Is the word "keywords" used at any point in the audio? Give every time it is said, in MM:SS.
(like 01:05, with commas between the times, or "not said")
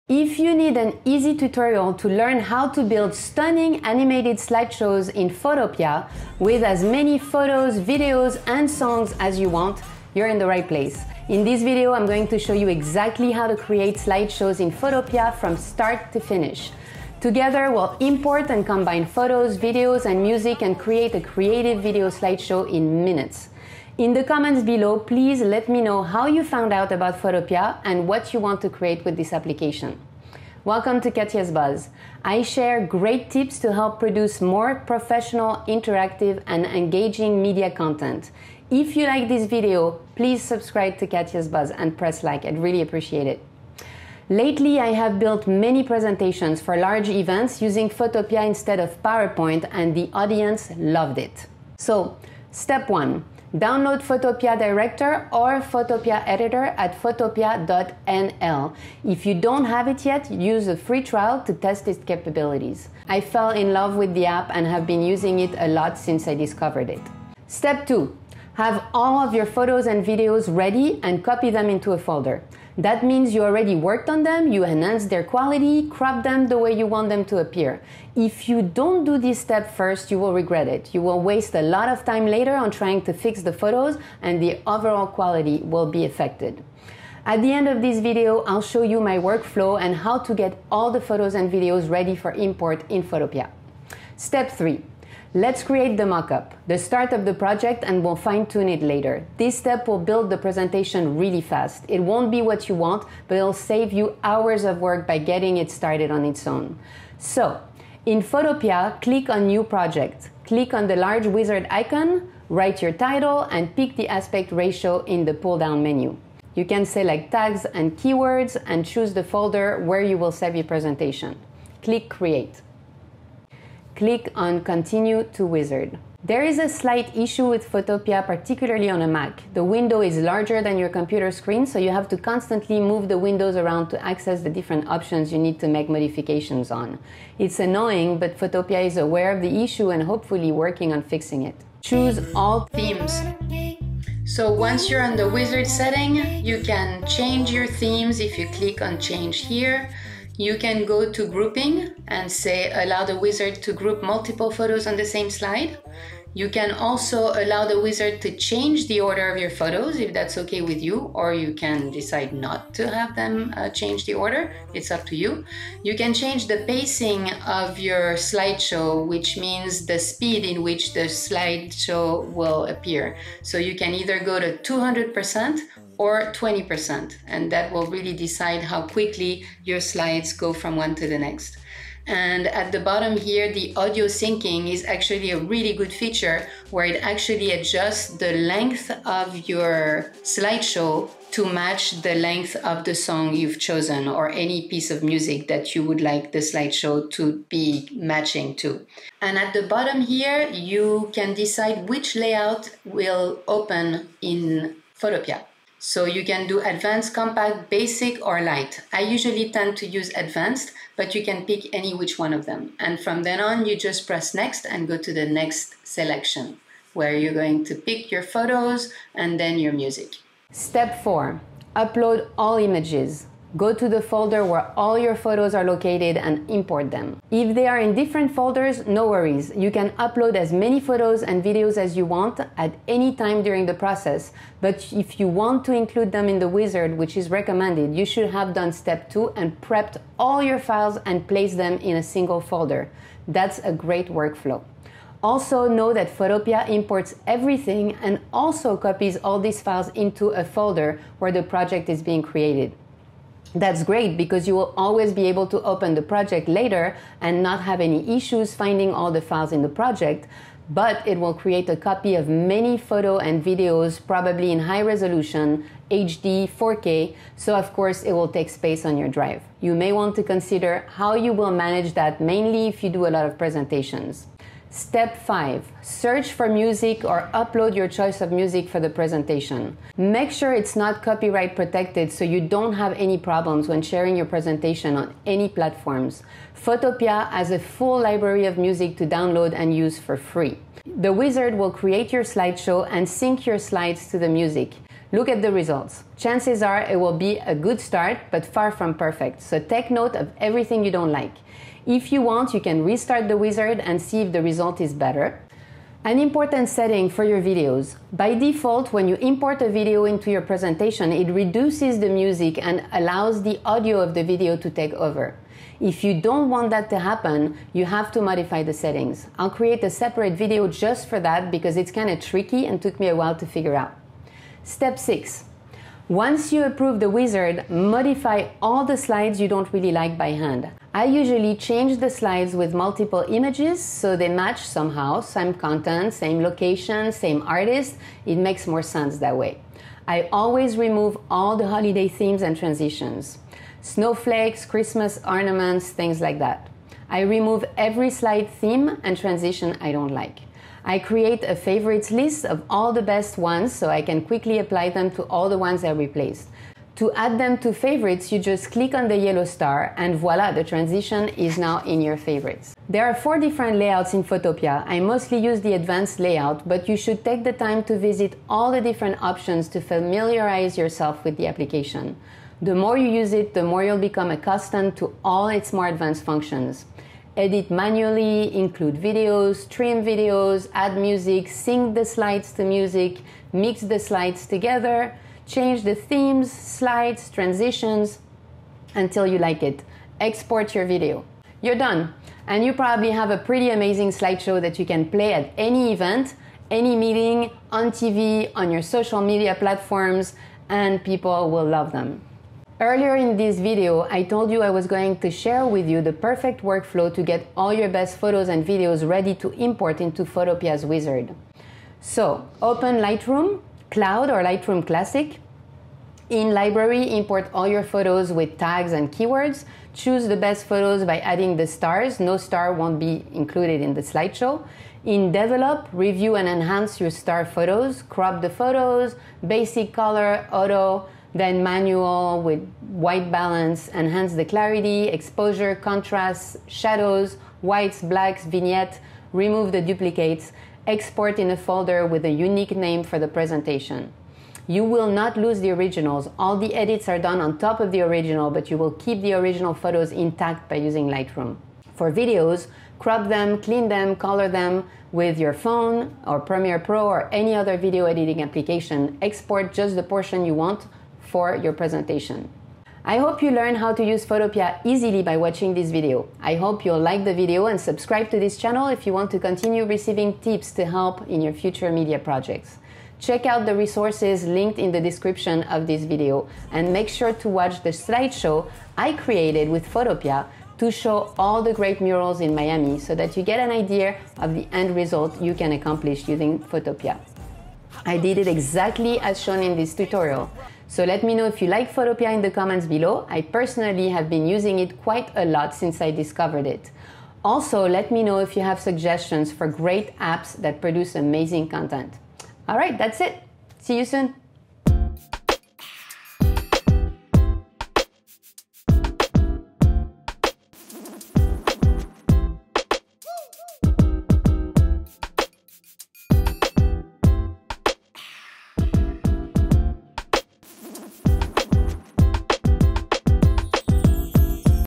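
01:57, 06:59.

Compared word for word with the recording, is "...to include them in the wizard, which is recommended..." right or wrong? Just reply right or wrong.
right.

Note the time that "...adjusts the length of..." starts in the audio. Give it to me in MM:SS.
03:07.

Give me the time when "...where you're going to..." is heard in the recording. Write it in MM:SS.
03:36.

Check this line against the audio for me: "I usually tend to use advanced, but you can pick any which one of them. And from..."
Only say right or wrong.
right.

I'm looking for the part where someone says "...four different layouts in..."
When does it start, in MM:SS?
06:03.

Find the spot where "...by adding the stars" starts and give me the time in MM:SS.
07:01.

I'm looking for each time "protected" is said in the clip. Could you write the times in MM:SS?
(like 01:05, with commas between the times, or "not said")
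04:41.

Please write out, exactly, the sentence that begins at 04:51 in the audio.
The wizard will create your slideshow and sync your slides to the music.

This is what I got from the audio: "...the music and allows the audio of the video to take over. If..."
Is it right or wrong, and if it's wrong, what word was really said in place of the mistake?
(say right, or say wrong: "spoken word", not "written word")
right.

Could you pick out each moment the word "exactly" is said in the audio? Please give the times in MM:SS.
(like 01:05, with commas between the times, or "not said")
00:12, 08:08.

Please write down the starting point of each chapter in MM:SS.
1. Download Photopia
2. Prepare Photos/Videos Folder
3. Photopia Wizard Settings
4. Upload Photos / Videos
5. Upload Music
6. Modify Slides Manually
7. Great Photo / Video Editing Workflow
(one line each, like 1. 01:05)
1. 00:56
2. 01:07
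3. 01:35
4. 03:42
5. 04:36
6. 05:28
7. 06:45.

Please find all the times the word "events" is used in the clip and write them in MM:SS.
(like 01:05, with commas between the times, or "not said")
00:47, 06:35.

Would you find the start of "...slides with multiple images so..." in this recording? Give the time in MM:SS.
05:32.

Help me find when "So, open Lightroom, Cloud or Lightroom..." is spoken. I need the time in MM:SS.
06:51.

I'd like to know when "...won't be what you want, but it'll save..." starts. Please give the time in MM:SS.
01:42.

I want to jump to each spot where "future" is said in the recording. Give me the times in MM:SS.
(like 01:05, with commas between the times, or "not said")
07:51.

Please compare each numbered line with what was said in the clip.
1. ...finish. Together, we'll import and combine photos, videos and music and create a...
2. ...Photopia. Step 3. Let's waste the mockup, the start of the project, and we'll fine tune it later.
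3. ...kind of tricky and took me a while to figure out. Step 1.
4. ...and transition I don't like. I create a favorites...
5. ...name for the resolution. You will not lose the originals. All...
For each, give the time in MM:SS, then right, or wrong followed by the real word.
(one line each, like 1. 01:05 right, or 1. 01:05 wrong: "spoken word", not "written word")
1. 00:16 right
2. 01:33 wrong: "create", not "waste"
3. 05:21 wrong: "6", not "1"
4. 05:49 right
5. 07:22 wrong: "presentation", not "resolution".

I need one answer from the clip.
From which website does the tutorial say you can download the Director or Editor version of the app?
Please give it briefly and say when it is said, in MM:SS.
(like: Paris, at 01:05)
photopia.nl, at 00:57.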